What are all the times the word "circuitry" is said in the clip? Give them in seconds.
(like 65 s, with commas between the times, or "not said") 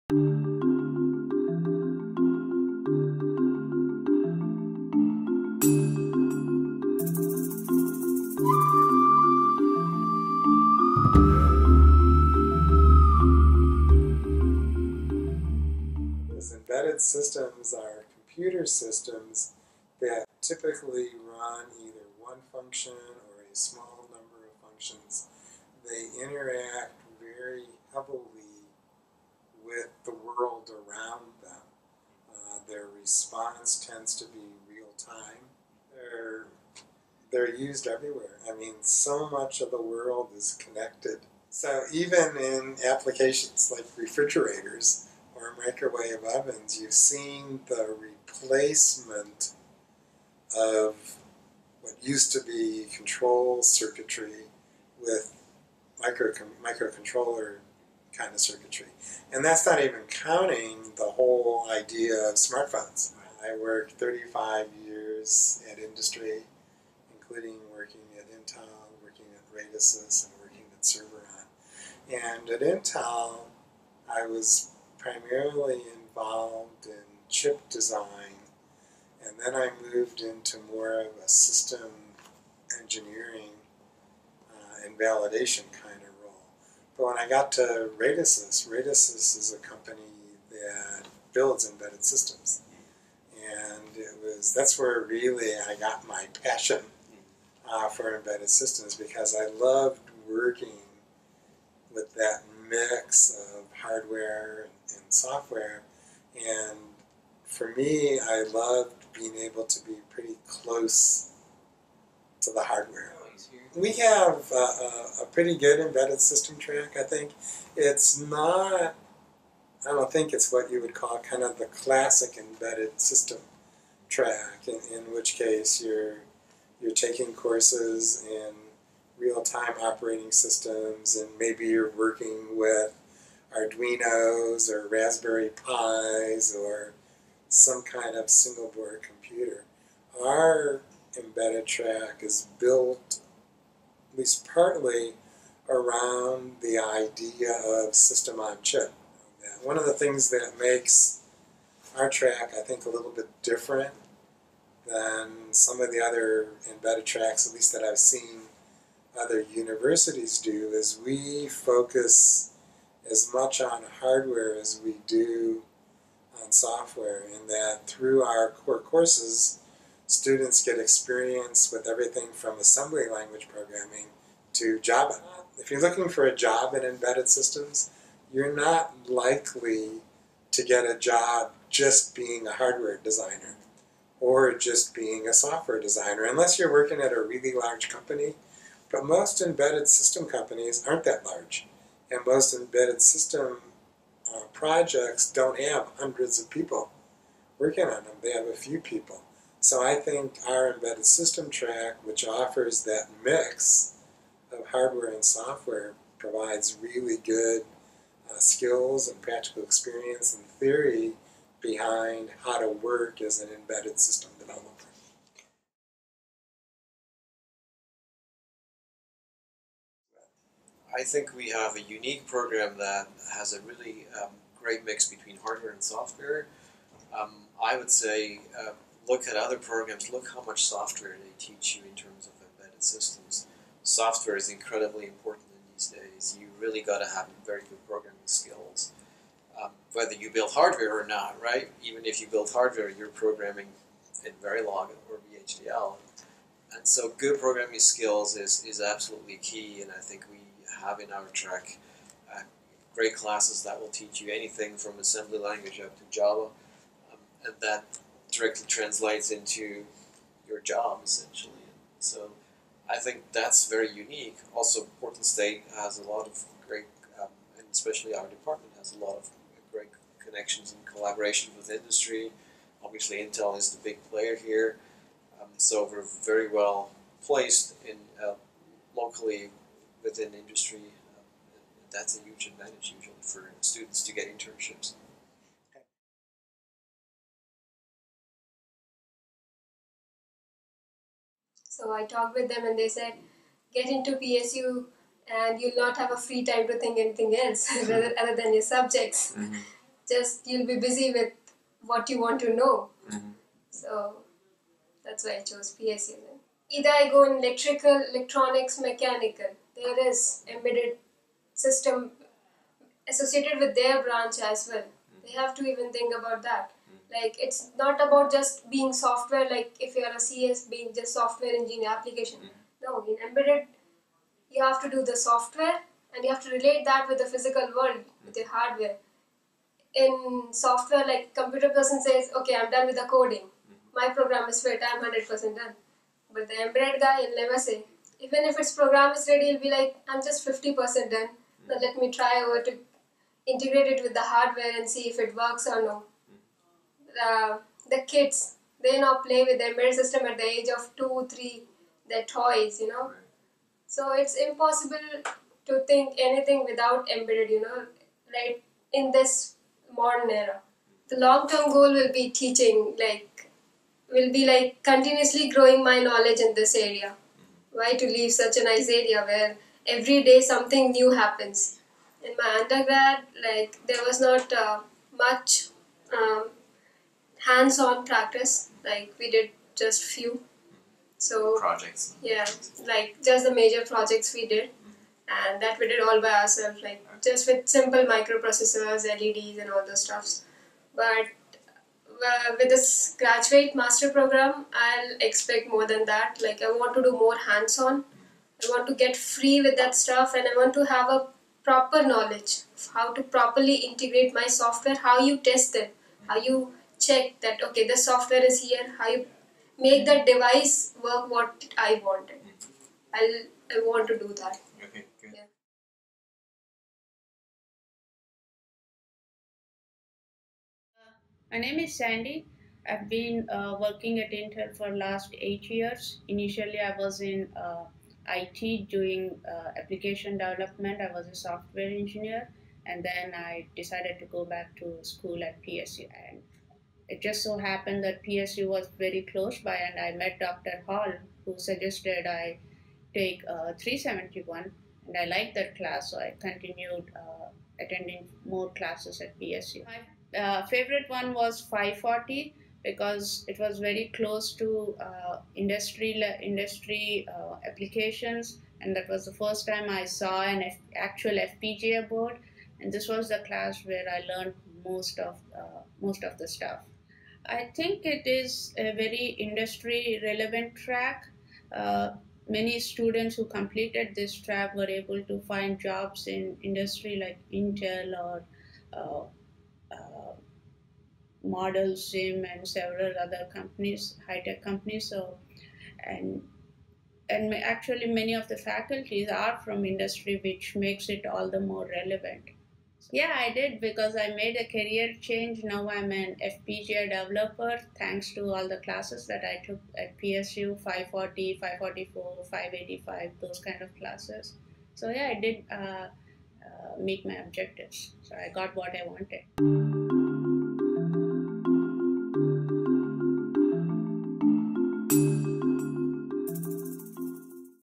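53 s, 58 s.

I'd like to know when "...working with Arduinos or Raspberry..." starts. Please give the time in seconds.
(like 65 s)
131 s.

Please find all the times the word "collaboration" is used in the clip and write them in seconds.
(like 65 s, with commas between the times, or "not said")
270 s.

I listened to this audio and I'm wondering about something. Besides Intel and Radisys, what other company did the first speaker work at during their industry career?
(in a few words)
Serveron.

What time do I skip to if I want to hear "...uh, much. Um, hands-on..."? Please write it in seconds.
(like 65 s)
374 s.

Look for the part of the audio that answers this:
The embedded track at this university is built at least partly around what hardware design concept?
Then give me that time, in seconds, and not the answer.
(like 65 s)
147 s.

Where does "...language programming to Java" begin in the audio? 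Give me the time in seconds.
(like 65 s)
173 s.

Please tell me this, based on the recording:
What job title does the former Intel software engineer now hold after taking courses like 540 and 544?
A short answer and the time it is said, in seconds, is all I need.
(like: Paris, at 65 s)
FPGA developer, at 496 s.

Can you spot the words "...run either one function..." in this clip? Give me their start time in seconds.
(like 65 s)
21 s.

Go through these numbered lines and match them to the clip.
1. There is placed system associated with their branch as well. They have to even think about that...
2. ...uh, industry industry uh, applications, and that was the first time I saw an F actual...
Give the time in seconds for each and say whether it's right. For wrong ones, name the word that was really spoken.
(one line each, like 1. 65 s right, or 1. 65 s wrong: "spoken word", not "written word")
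1. 309 s wrong: "embedded", not "placed"
2. 455 s right.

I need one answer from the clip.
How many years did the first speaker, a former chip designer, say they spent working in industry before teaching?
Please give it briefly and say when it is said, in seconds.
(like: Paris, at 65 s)
35, at 63 s.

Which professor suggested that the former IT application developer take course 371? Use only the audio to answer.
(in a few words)
Dr. Hall.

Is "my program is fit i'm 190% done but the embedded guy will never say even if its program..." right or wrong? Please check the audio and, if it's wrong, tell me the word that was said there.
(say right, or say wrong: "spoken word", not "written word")
wrong: "100", not "190".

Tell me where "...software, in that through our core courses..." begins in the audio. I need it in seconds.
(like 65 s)
166 s.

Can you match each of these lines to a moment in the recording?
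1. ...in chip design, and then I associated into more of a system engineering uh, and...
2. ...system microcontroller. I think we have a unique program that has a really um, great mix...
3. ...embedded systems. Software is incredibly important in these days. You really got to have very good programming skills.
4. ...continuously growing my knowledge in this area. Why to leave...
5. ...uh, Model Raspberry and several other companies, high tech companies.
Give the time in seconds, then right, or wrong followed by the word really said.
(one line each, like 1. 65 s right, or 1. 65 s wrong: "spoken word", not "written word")
1. 76 s wrong: "moved", not "associated"
2. 213 s wrong: "developer", not "microcontroller"
3. 232 s right
4. 364 s right
5. 479 s wrong: "Sim", not "Raspberry".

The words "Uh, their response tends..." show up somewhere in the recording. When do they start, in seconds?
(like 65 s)
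32 s.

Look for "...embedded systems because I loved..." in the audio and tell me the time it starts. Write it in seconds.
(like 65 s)
98 s.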